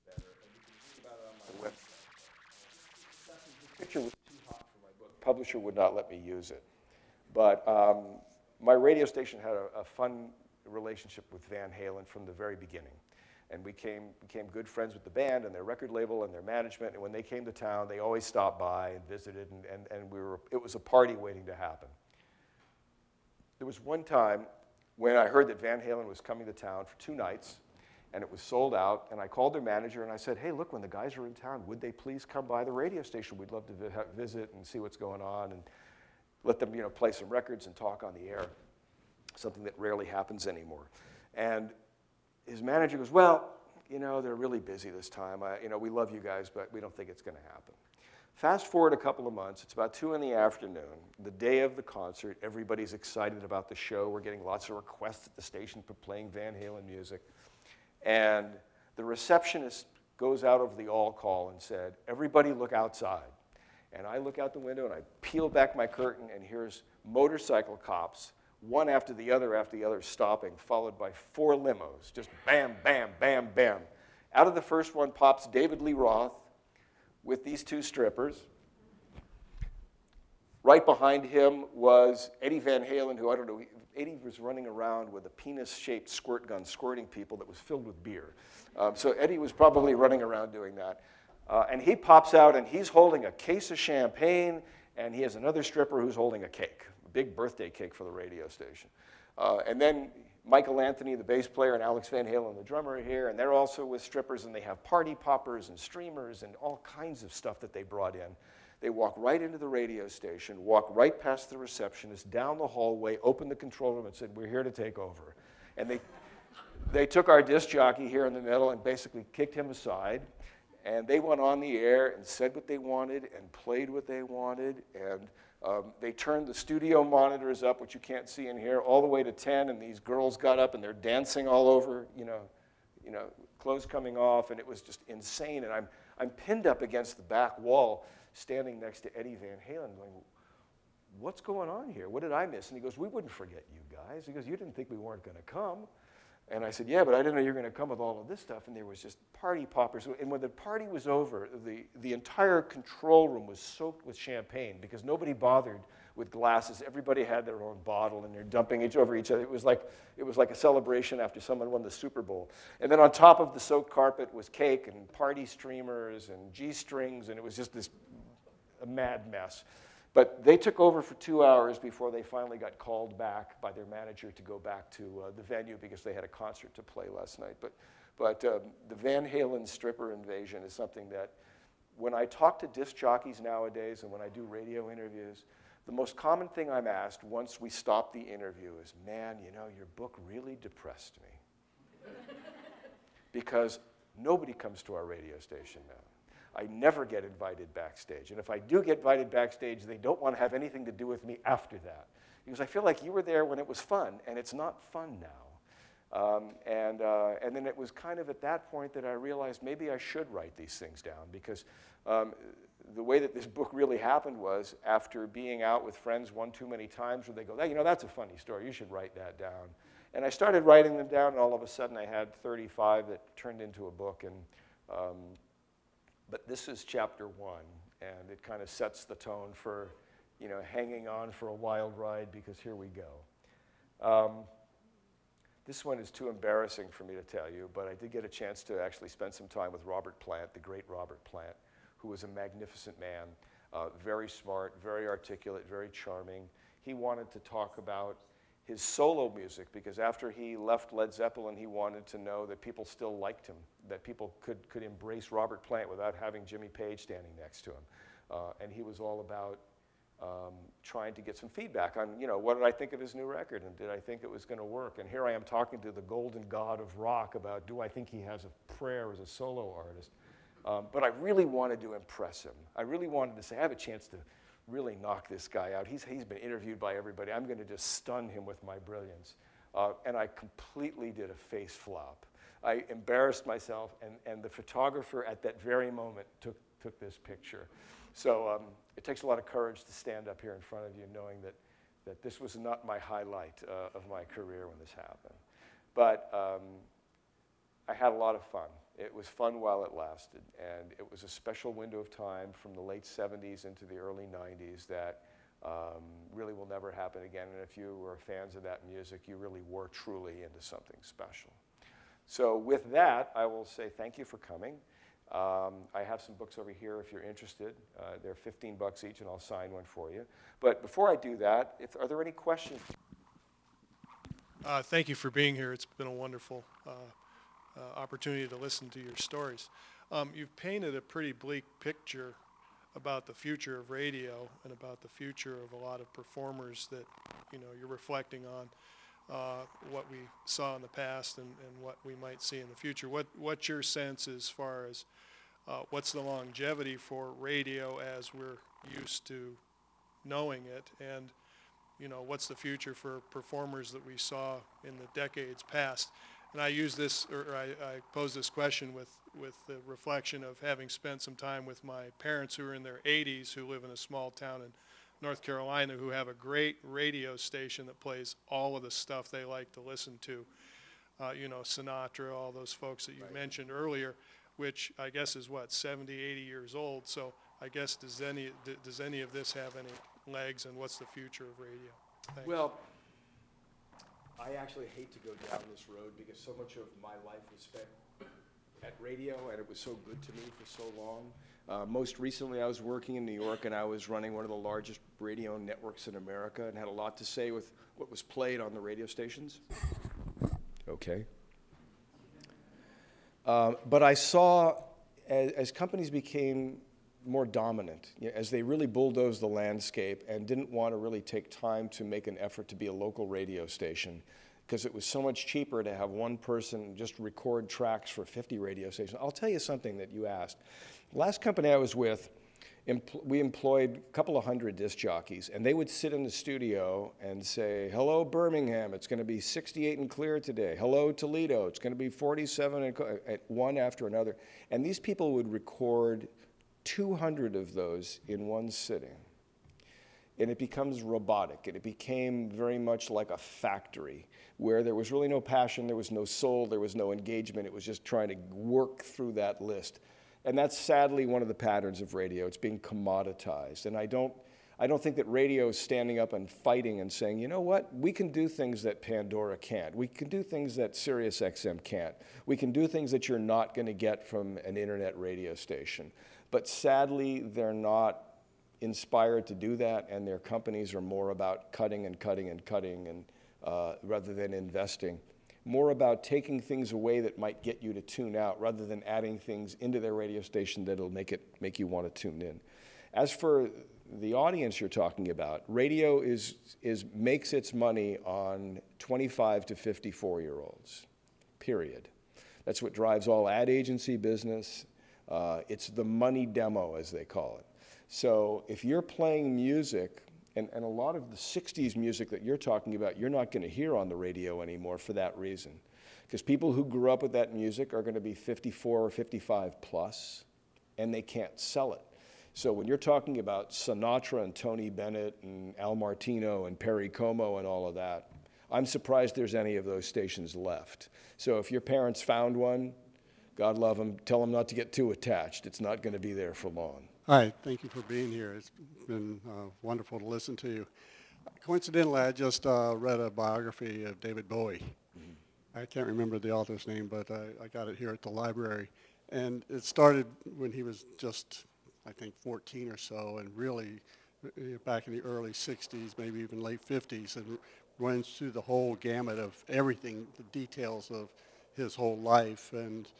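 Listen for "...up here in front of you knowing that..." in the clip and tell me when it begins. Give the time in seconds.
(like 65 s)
290 s.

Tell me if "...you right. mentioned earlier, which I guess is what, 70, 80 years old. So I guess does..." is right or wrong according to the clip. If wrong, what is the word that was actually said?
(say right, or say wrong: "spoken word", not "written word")
right.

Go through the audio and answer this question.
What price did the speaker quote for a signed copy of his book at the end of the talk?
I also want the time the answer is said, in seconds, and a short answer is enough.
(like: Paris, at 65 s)
$15, at 318 s.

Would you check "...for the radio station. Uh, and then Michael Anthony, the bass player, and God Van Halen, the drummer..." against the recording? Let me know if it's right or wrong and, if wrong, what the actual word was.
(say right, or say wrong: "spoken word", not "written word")
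wrong: "Alex", not "God".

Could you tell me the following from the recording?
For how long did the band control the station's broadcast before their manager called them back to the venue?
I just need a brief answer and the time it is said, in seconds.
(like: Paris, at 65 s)
2 hours, at 171 s.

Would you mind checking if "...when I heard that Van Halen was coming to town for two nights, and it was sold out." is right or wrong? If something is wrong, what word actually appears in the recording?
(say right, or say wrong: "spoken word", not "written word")
right.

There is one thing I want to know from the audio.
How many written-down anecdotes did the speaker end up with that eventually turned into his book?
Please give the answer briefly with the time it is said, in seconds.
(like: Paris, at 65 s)
35, at 222 s.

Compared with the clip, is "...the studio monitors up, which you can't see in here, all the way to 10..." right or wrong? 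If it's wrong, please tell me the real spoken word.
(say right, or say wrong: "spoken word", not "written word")
right.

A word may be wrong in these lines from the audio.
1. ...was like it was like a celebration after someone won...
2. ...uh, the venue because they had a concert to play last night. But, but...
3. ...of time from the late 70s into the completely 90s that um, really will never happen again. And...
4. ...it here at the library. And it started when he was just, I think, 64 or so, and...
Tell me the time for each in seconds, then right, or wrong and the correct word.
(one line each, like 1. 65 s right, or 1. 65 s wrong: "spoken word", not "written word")
1. 159 s right
2. 175 s right
3. 301 s wrong: "early", not "completely"
4. 537 s wrong: "14", not "64".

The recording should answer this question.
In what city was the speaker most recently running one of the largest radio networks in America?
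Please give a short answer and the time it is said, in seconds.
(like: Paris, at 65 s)
New York, at 393 s.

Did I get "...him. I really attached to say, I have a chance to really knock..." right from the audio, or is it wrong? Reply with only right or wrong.
wrong.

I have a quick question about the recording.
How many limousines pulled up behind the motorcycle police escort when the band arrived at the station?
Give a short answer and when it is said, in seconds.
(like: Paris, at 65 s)
4, at 71 s.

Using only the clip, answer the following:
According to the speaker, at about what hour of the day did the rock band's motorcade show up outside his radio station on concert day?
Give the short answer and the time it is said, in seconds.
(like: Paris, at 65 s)
2 in the afternoon, at 49 s.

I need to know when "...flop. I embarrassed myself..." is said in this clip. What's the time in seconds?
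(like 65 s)
281 s.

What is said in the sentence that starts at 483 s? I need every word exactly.
As for the audience you're talking about, radio is, is makes its money on 25 to 54 year olds, period.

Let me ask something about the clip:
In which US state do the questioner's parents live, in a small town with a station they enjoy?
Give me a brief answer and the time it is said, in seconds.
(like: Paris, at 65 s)
North Carolina, at 365 s.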